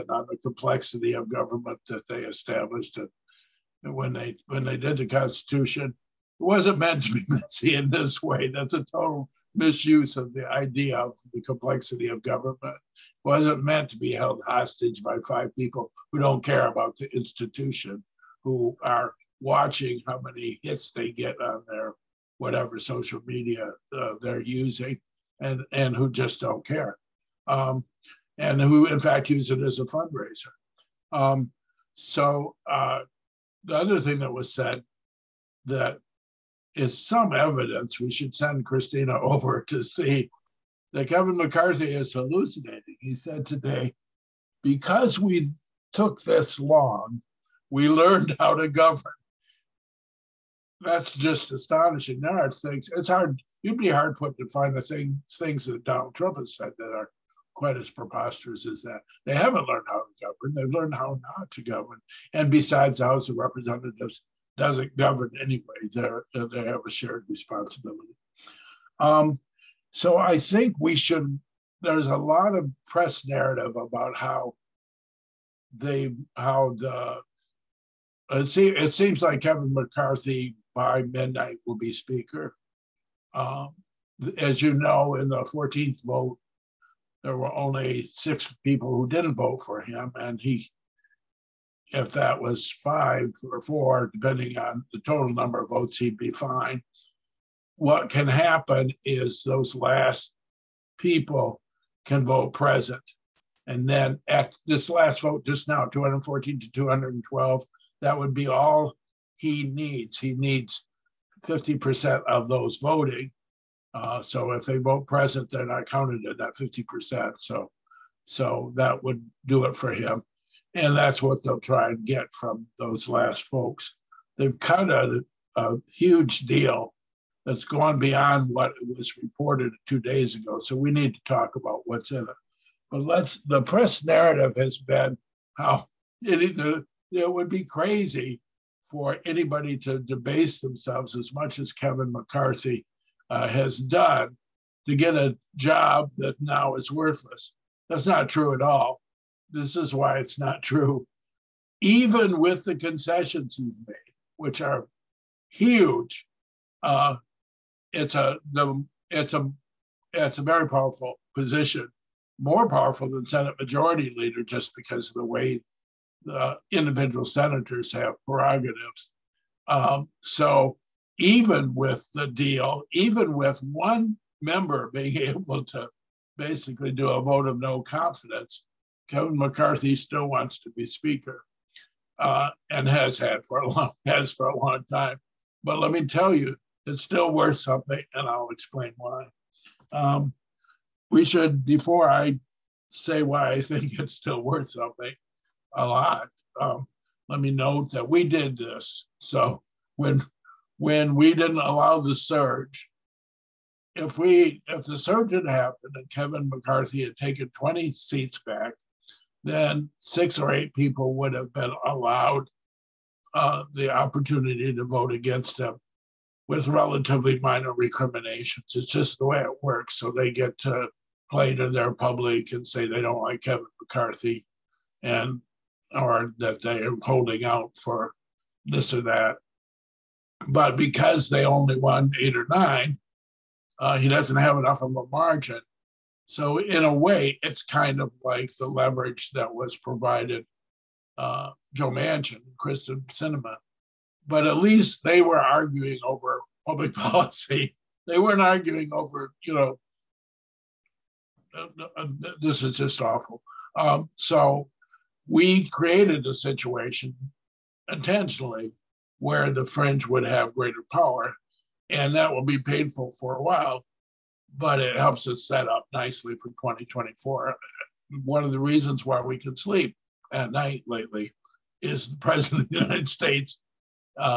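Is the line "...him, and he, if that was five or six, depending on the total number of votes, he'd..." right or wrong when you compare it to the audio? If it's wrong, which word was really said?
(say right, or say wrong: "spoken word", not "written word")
wrong: "four", not "six".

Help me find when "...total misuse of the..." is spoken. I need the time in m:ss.
0:08.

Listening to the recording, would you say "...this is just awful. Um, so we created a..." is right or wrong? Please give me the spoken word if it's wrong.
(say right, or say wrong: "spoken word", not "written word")
right.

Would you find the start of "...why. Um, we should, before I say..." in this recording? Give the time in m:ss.
3:08.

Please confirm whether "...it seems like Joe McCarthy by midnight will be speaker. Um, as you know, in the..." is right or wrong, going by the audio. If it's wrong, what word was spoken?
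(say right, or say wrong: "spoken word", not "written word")
wrong: "Kevin", not "Joe".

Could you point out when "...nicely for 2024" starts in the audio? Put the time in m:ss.
4:25.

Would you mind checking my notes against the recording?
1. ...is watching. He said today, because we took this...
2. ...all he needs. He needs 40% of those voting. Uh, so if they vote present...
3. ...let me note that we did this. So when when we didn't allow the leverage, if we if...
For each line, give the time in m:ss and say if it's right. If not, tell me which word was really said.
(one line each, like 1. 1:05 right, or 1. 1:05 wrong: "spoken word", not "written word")
1. 0:41 wrong: "hallucinating", not "watching"
2. 1:48 wrong: "50", not "40"
3. 3:17 wrong: "surge", not "leverage".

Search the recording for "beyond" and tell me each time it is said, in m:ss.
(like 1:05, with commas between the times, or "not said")
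2:07.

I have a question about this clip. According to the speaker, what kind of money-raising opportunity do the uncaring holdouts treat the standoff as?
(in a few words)
fundraiser.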